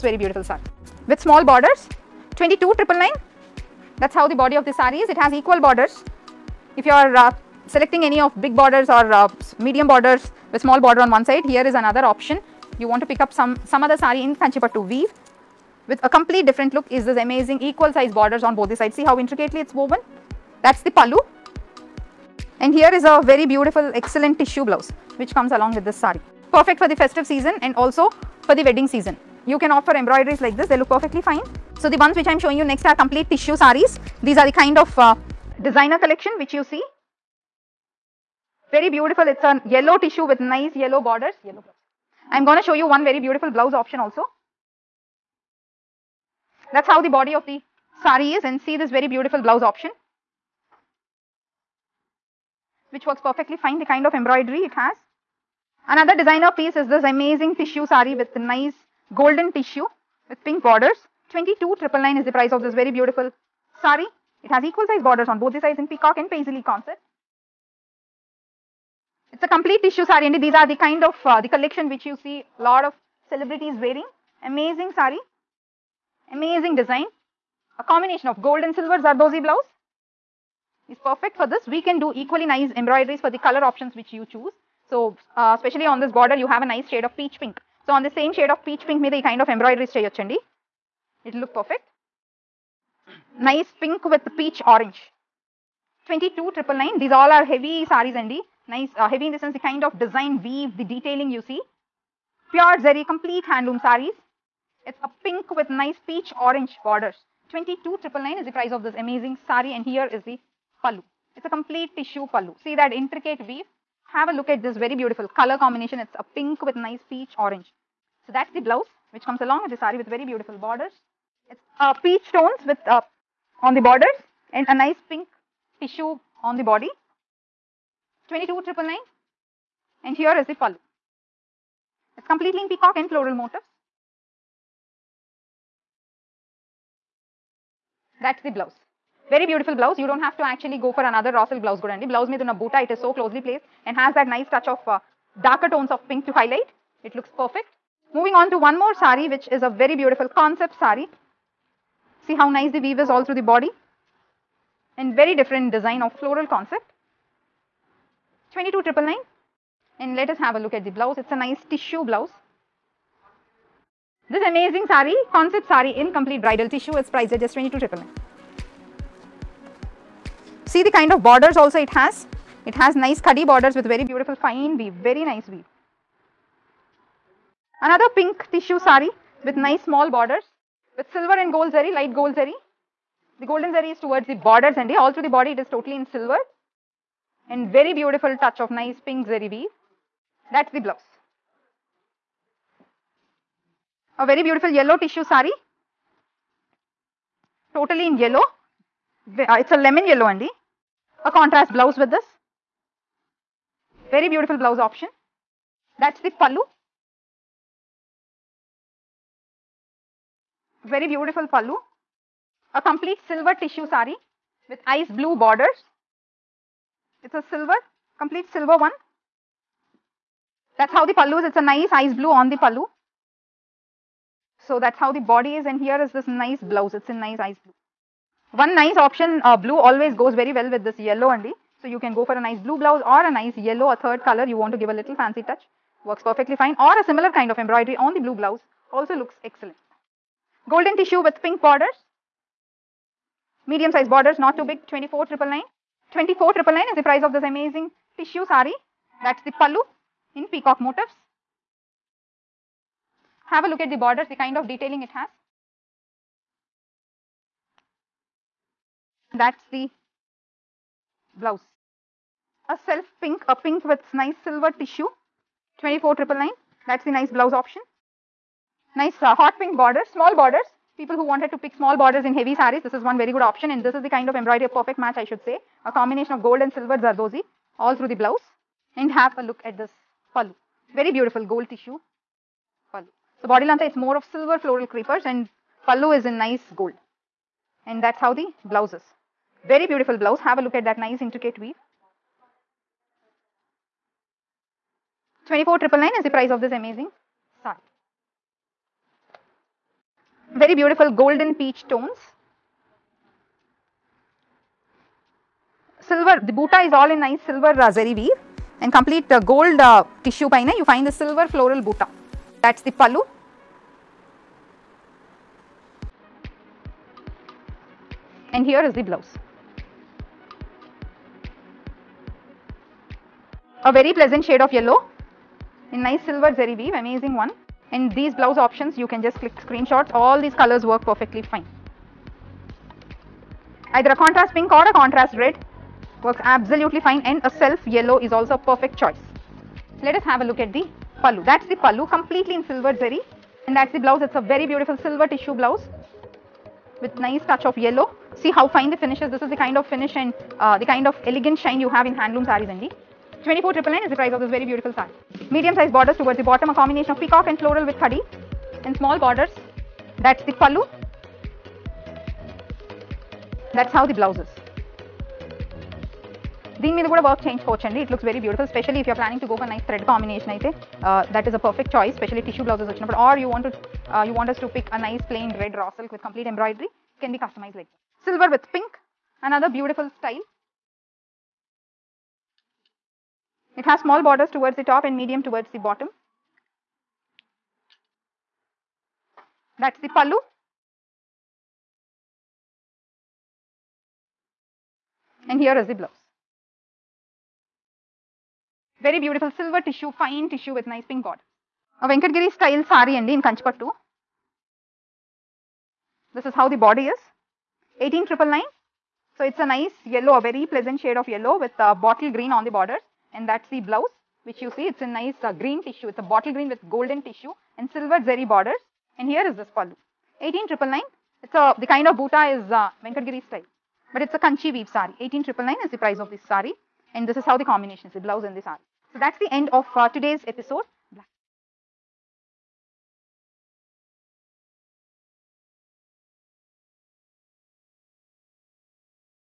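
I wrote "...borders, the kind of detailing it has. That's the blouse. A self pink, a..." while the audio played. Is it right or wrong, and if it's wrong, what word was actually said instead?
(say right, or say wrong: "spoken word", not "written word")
right.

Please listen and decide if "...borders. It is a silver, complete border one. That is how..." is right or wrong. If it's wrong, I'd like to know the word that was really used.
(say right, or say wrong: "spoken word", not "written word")
wrong: "silver", not "border".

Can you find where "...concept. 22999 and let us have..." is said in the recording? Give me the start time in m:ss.
2:36.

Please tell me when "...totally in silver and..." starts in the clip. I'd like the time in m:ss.
3:05.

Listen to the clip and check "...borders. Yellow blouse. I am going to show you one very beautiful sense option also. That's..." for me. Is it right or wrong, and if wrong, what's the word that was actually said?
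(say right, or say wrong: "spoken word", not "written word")
wrong: "blouse", not "sense".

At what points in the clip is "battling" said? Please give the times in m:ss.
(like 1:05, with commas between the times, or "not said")
not said.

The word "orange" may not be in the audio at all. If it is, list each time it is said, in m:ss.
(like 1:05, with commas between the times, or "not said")
1:34, 1:46, 1:57.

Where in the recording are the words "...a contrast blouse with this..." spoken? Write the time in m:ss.
3:21.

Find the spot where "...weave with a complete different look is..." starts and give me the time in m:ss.
0:14.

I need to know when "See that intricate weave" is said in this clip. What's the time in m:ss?
1:52.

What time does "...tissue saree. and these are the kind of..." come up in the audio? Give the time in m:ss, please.
1:09.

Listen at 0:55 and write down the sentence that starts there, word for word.
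Another designer piece is this amazing tissue sari with nice golden tissue with pink borders.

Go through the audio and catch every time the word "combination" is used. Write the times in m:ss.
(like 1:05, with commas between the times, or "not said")
1:17, 1:55, 4:35, 5:56, 7:07.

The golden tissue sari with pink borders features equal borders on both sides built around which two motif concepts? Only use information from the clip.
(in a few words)
peacock and paisley.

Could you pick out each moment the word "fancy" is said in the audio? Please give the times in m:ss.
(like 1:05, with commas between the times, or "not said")
3:55.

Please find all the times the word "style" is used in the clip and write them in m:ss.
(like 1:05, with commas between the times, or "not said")
6:20, 6:42, 7:03.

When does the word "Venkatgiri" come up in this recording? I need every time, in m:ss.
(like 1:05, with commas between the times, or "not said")
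6:42, 7:03.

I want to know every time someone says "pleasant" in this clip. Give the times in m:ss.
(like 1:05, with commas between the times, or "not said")
5:24, 6:50.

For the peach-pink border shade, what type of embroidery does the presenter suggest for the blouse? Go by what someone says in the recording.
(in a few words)
cheyochandi.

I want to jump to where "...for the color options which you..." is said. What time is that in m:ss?
1:23.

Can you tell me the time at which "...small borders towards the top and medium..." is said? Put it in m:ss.
6:24.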